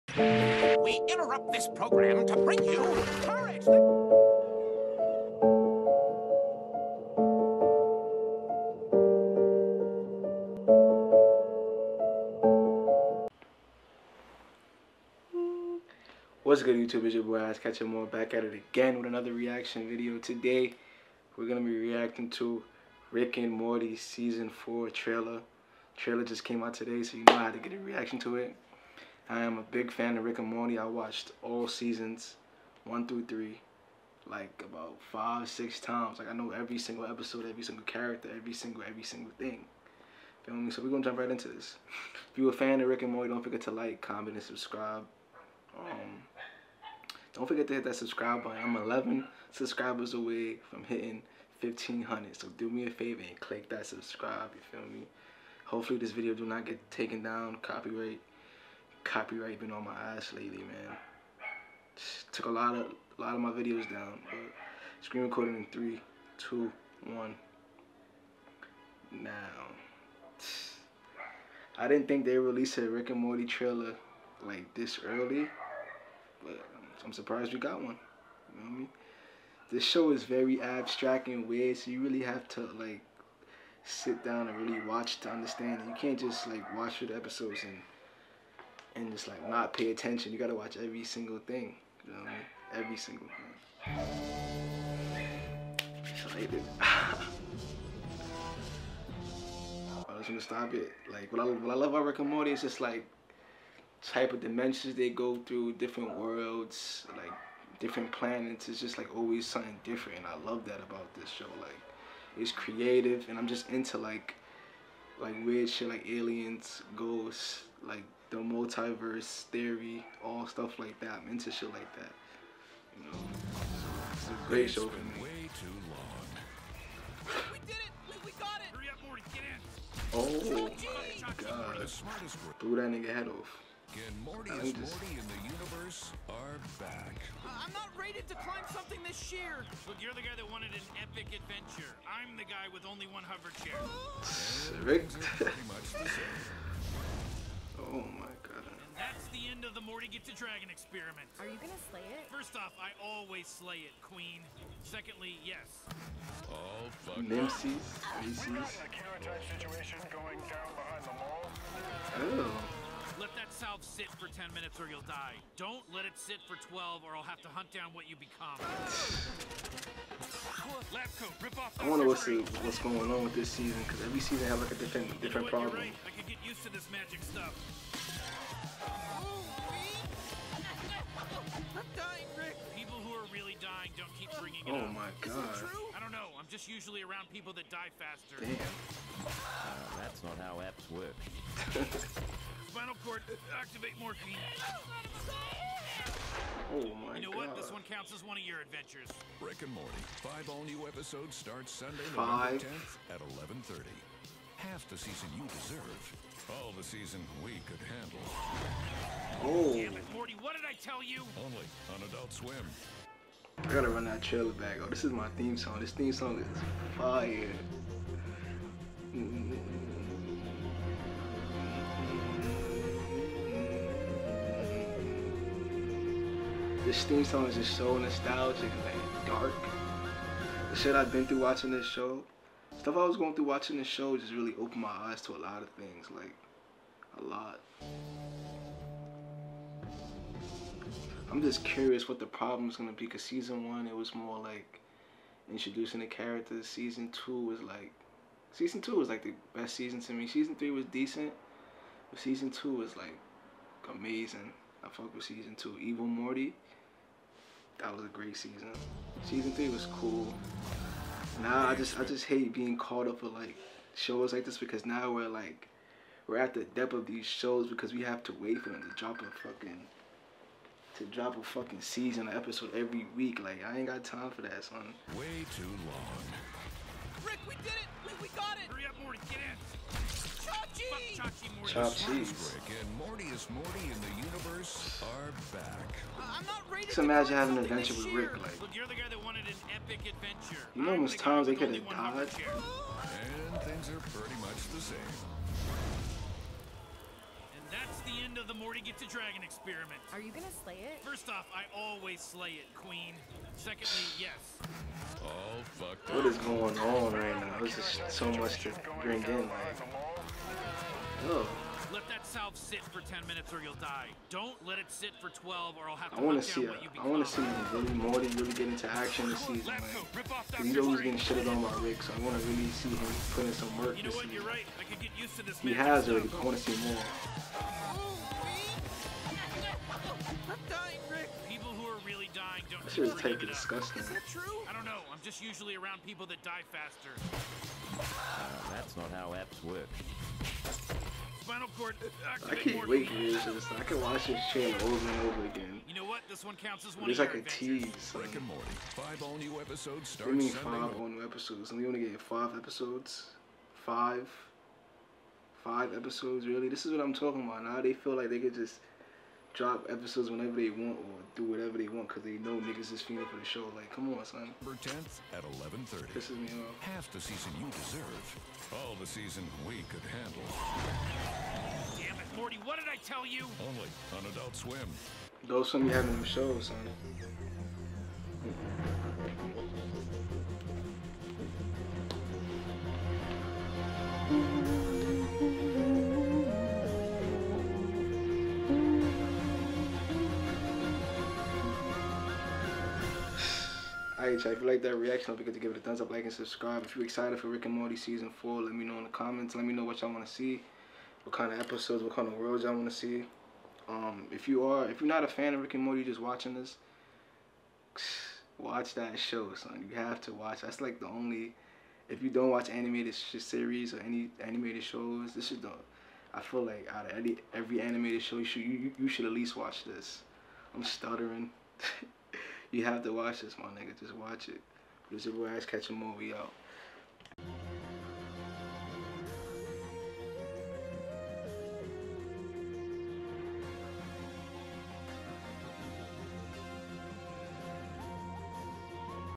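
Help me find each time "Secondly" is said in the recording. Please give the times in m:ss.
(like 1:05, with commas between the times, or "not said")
2:34, 5:03.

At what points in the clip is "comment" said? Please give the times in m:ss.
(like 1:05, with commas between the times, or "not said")
0:43, 6:39.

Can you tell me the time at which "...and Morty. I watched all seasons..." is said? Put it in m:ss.
0:30.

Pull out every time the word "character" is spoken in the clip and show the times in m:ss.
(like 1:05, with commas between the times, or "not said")
0:37, 4:06.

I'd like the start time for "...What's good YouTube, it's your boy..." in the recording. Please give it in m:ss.
0:16.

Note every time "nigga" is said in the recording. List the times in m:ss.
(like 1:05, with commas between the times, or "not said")
2:12, 6:02, 7:03.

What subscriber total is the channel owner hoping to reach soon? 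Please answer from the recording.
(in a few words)
1500.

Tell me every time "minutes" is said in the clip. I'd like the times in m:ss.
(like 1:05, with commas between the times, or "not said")
2:44, 5:13.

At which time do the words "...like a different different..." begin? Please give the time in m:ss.
2:54.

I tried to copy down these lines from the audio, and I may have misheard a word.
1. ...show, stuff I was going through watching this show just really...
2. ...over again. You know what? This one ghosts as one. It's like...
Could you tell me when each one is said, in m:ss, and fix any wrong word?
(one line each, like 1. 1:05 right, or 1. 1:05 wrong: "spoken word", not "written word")
1. 3:51 right
2. 5:45 wrong: "counts", not "ghosts".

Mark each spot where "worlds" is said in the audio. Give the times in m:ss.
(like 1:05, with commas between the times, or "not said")
1:46, 6:42.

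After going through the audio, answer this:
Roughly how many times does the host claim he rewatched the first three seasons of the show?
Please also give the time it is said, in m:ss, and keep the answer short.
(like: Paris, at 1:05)
5 or 6 times, at 0:35.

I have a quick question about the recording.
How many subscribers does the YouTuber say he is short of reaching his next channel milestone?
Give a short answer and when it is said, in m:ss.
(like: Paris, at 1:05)
11, at 0:48.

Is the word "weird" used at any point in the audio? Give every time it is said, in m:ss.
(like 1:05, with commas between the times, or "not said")
1:21, 1:55.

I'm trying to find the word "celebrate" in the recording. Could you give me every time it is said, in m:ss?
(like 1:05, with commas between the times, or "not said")
not said.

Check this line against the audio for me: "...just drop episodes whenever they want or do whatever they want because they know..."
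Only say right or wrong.
right.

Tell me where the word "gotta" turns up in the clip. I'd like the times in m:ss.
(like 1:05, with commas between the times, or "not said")
1:30, 3:33.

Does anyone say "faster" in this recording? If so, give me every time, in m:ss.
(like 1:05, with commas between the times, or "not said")
3:08, 5:36.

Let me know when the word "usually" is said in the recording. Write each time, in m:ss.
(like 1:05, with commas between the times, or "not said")
3:06, 5:35.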